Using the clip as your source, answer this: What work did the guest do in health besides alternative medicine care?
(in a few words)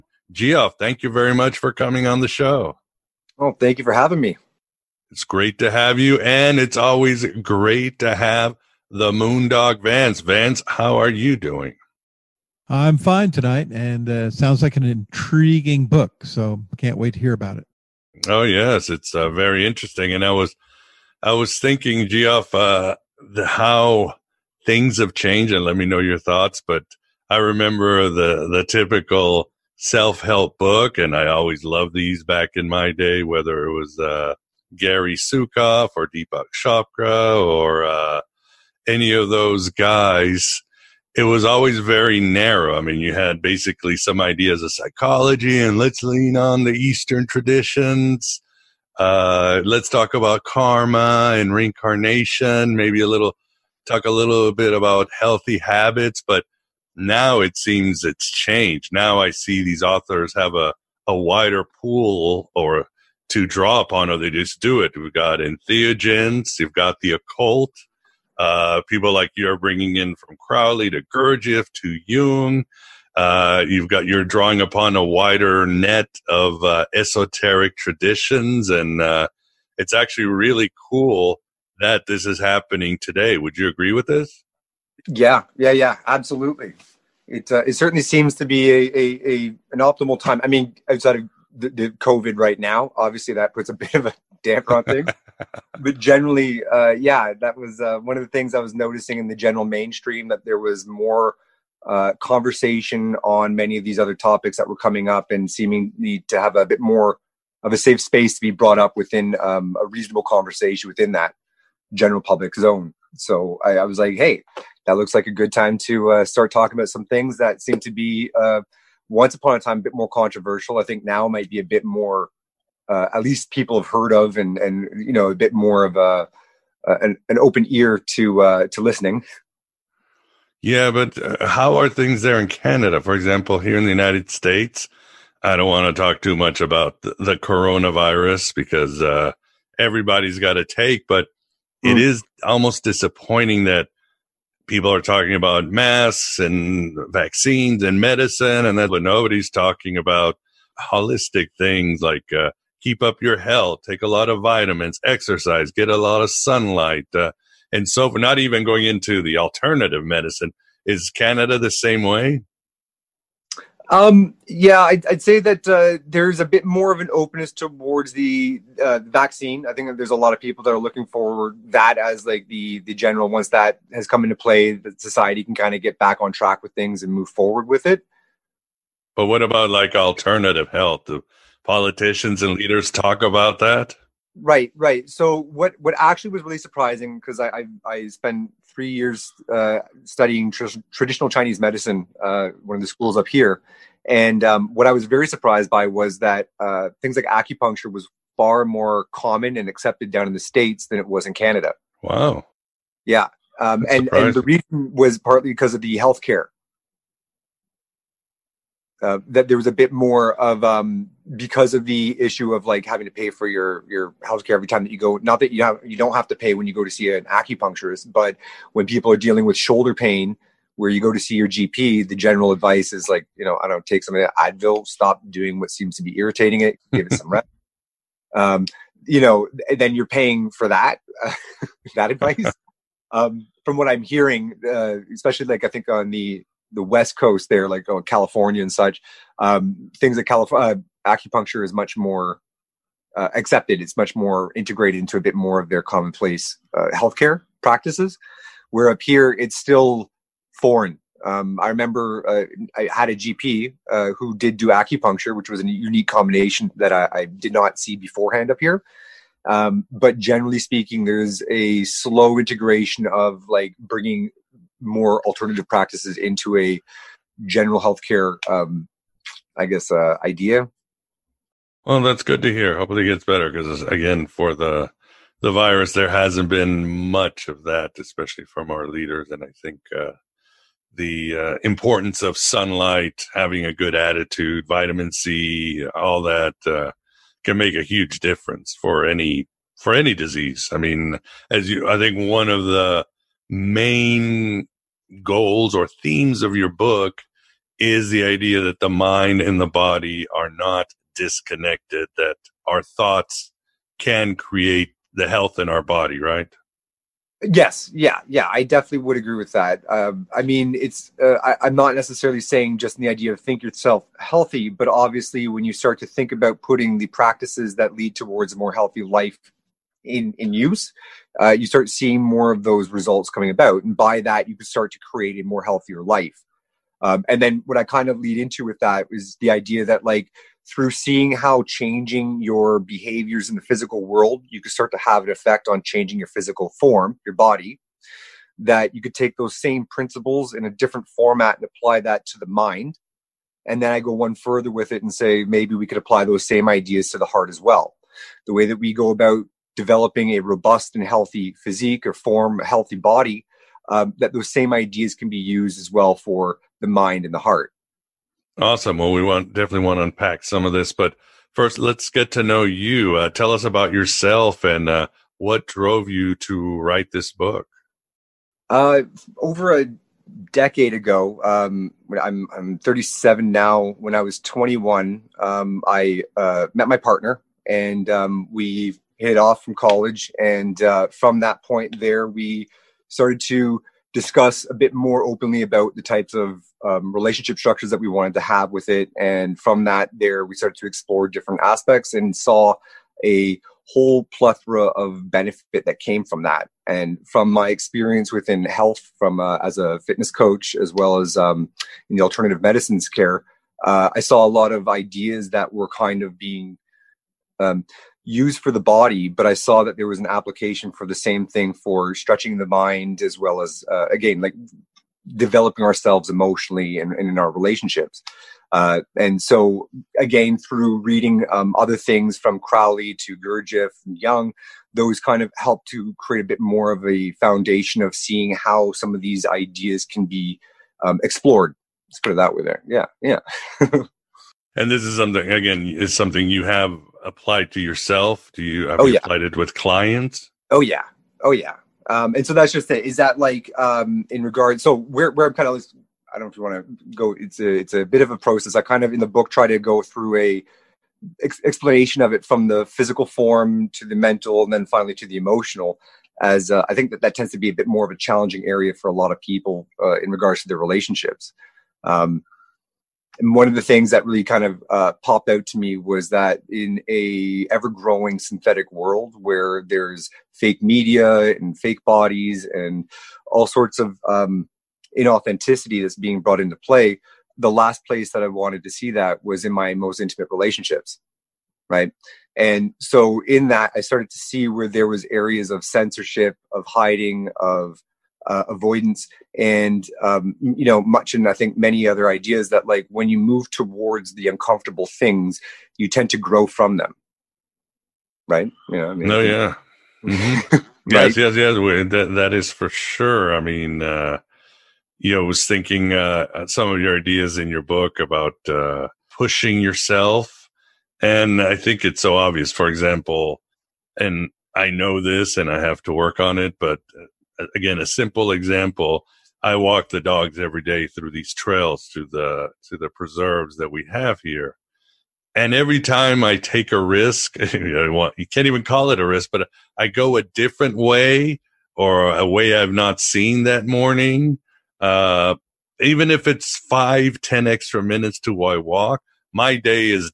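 fitness coach.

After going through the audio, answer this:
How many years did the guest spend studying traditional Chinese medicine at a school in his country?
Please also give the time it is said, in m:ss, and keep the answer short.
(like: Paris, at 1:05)
3, at 3:08.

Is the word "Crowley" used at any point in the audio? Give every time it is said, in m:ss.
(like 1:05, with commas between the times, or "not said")
1:10, 7:02.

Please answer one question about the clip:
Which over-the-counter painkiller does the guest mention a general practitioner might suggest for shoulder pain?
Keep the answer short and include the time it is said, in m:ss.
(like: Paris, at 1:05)
Advil, at 3:44.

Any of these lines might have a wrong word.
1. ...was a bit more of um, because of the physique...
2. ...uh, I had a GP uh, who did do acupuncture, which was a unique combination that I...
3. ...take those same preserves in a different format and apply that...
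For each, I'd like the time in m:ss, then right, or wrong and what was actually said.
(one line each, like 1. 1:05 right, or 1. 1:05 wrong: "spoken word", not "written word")
1. 3:29 wrong: "issue", not "physique"
2. 4:12 right
3. 5:39 wrong: "principles", not "preserves".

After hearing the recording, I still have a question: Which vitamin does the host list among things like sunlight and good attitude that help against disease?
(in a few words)
vitamin C.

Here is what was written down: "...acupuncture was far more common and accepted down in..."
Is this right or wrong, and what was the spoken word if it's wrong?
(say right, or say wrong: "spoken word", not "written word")
right.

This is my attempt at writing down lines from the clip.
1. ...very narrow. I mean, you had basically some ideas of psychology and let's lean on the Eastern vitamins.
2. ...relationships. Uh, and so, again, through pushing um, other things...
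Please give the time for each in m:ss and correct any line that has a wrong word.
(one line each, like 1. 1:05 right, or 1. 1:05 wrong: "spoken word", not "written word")
1. 0:41 wrong: "traditions", not "vitamins"
2. 6:57 wrong: "reading", not "pushing".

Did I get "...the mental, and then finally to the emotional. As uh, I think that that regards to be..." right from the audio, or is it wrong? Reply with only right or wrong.
wrong.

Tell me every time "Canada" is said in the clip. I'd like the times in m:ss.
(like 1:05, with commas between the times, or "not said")
2:12, 2:41, 3:21.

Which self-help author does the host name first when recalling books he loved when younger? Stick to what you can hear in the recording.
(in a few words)
Gary Zukav.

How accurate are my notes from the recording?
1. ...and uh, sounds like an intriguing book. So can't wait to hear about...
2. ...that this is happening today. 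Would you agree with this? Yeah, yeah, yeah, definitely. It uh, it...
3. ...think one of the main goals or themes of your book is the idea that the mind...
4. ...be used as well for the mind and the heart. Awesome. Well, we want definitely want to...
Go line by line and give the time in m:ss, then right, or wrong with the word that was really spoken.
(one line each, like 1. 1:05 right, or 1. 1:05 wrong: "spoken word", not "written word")
1. 0:13 right
2. 1:21 wrong: "absolutely", not "definitely"
3. 4:51 right
4. 5:55 right.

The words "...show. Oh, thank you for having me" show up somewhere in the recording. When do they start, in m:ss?
0:02.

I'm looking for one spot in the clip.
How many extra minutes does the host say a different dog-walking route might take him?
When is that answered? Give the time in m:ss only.
8:56.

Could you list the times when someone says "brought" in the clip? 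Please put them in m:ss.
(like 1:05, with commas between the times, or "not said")
1:48, 7:56.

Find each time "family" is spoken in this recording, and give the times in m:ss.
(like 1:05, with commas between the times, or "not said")
not said.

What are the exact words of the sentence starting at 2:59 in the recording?
But what about like alternative health?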